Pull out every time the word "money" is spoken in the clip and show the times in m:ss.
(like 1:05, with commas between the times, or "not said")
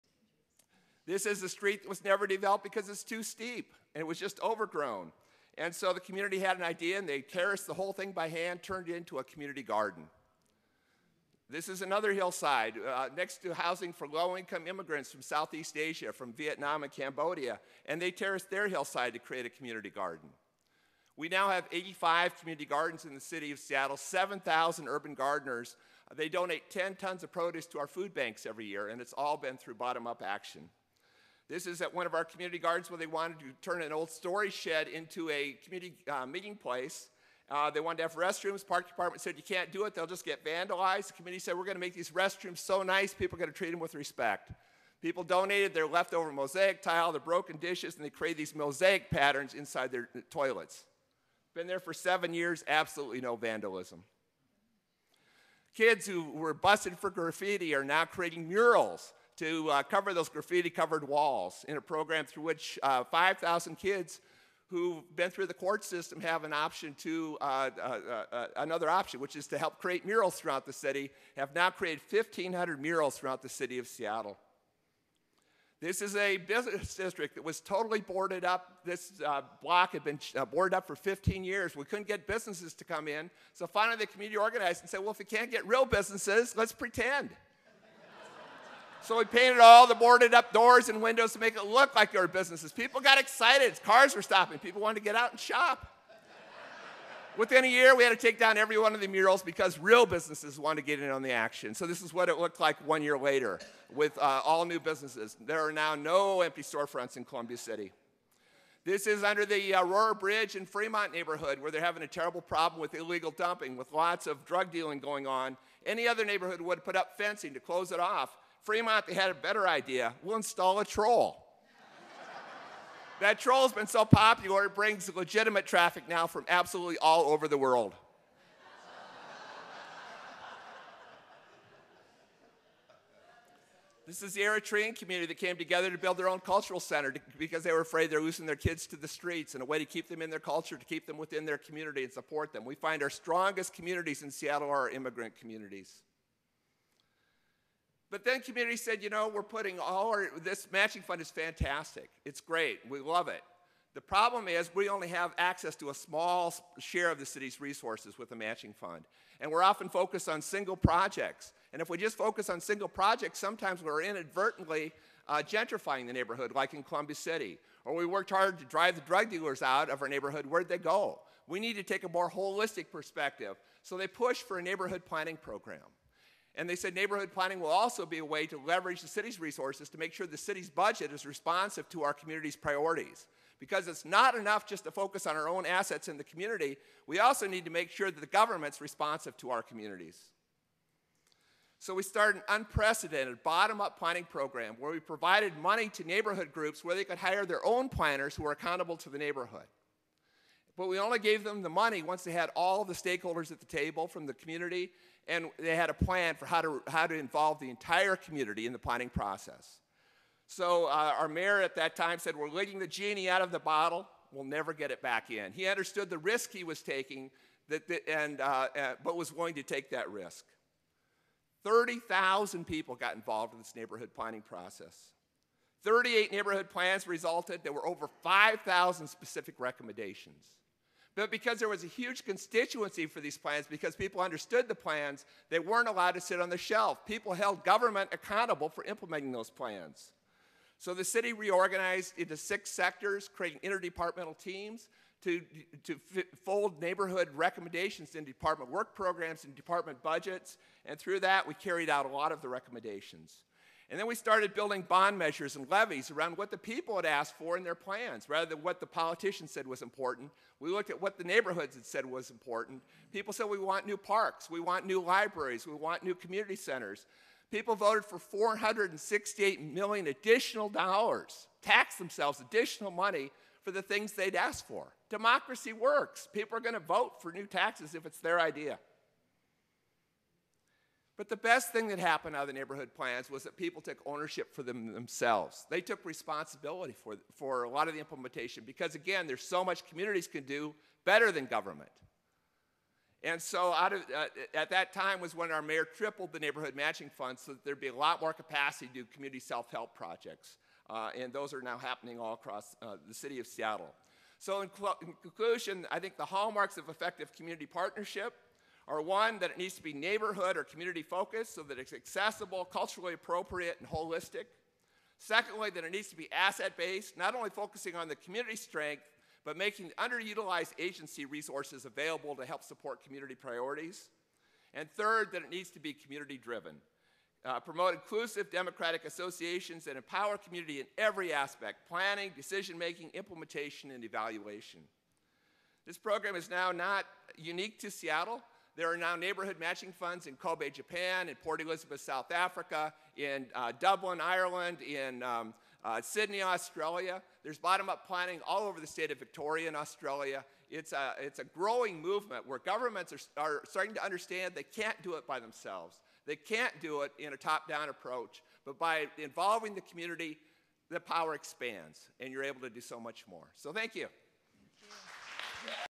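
3:15, 3:21, 4:32.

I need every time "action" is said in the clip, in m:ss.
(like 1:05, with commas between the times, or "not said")
0:30, 1:41.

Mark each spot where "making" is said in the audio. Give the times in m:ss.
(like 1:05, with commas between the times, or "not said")
5:19, 5:32.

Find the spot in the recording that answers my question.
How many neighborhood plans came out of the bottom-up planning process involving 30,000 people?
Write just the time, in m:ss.
3:45.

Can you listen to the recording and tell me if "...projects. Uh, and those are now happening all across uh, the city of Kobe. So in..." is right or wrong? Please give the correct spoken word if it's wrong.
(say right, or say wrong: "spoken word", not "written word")
wrong: "Seattle", not "Kobe".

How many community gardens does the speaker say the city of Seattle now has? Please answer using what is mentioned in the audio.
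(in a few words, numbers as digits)
85.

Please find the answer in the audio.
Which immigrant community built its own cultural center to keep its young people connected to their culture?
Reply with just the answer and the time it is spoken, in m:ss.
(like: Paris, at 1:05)
Eritrean, at 2:14.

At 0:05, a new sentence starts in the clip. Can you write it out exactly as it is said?
And so the community had an idea and they terraced the whole thing by hand, turned it into a community garden.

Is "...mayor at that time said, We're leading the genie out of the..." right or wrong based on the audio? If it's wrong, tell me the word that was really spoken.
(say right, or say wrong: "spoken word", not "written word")
right.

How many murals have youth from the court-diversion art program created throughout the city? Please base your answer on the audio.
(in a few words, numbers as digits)
1,500.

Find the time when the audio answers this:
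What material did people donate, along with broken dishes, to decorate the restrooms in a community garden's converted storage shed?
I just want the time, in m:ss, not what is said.
0:46.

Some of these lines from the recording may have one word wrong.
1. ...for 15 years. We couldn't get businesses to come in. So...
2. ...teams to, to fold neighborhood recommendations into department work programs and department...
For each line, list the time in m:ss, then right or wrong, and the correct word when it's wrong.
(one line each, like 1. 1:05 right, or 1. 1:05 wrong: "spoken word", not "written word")
1. 1:20 right
2. 4:04 right.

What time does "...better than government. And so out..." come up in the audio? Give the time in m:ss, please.
4:51.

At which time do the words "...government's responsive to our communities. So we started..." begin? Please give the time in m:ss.
3:08.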